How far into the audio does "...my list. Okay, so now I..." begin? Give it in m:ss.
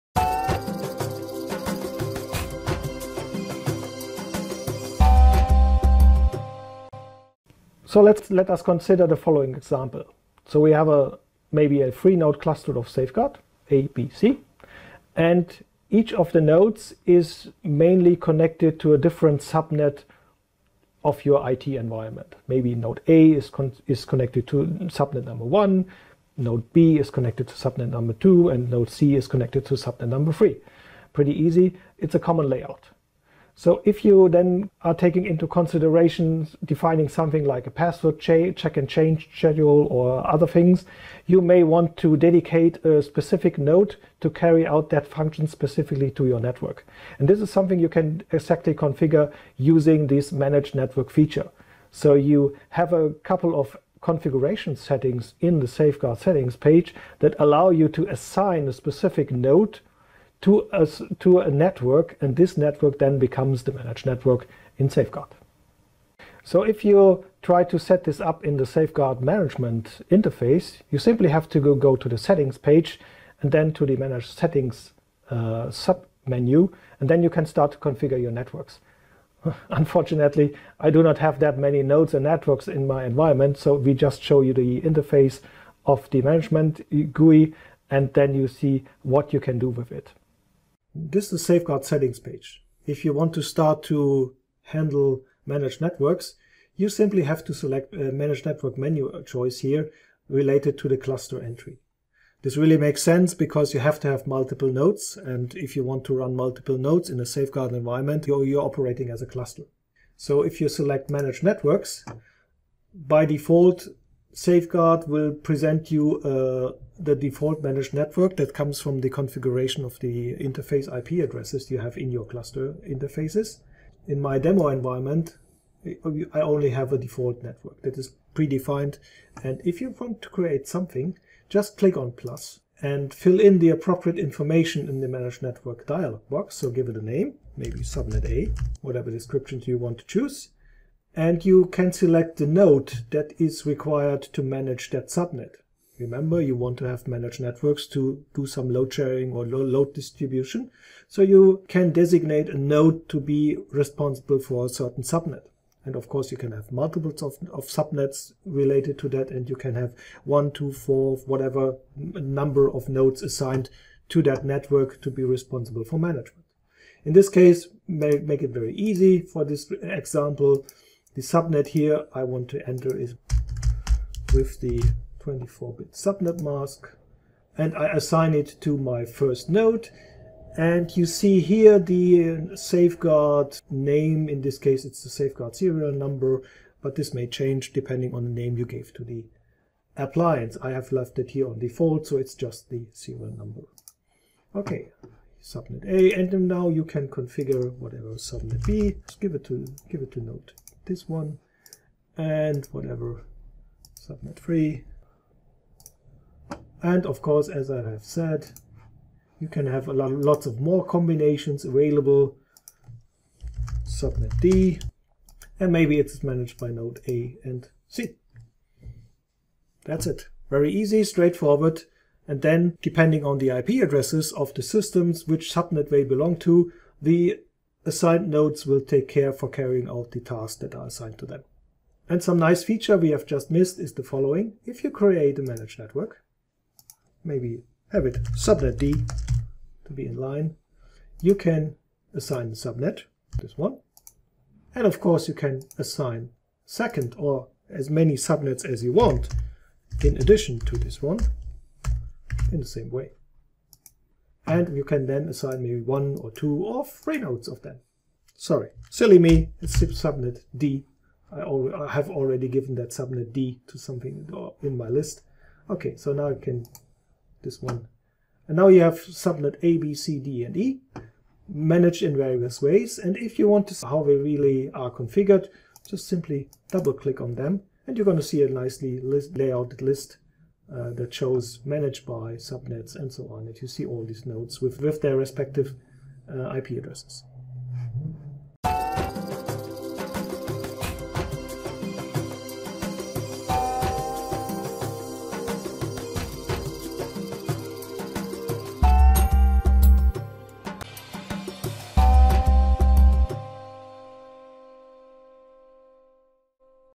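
4:24.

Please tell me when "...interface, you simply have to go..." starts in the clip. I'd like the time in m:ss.
1:10.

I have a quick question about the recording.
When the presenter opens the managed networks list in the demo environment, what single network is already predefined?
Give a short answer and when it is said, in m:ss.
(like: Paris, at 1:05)
default network, at 2:06.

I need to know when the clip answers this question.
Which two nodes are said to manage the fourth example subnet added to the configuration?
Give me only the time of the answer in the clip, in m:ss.
3:36.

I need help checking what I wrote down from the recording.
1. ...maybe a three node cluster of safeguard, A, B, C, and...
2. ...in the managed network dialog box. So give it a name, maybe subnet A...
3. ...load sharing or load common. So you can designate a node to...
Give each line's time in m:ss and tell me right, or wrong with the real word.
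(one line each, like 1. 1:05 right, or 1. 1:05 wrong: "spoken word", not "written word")
1. 0:11 right
2. 2:14 right
3. 2:28 wrong: "distribution", not "common".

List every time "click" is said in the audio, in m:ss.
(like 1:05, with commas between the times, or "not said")
2:11, 4:36.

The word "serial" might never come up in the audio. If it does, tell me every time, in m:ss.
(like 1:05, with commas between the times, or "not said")
3:05, 3:12.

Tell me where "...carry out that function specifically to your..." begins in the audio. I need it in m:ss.
0:44.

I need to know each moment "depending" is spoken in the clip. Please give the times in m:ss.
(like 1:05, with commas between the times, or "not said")
3:07, 3:42.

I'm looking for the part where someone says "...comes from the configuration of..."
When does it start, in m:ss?
1:58.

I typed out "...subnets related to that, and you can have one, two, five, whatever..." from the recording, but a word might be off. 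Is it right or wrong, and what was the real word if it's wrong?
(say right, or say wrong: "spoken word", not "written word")
wrong: "four", not "five".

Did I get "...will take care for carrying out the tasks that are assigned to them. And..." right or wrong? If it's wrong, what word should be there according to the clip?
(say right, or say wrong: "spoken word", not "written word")
right.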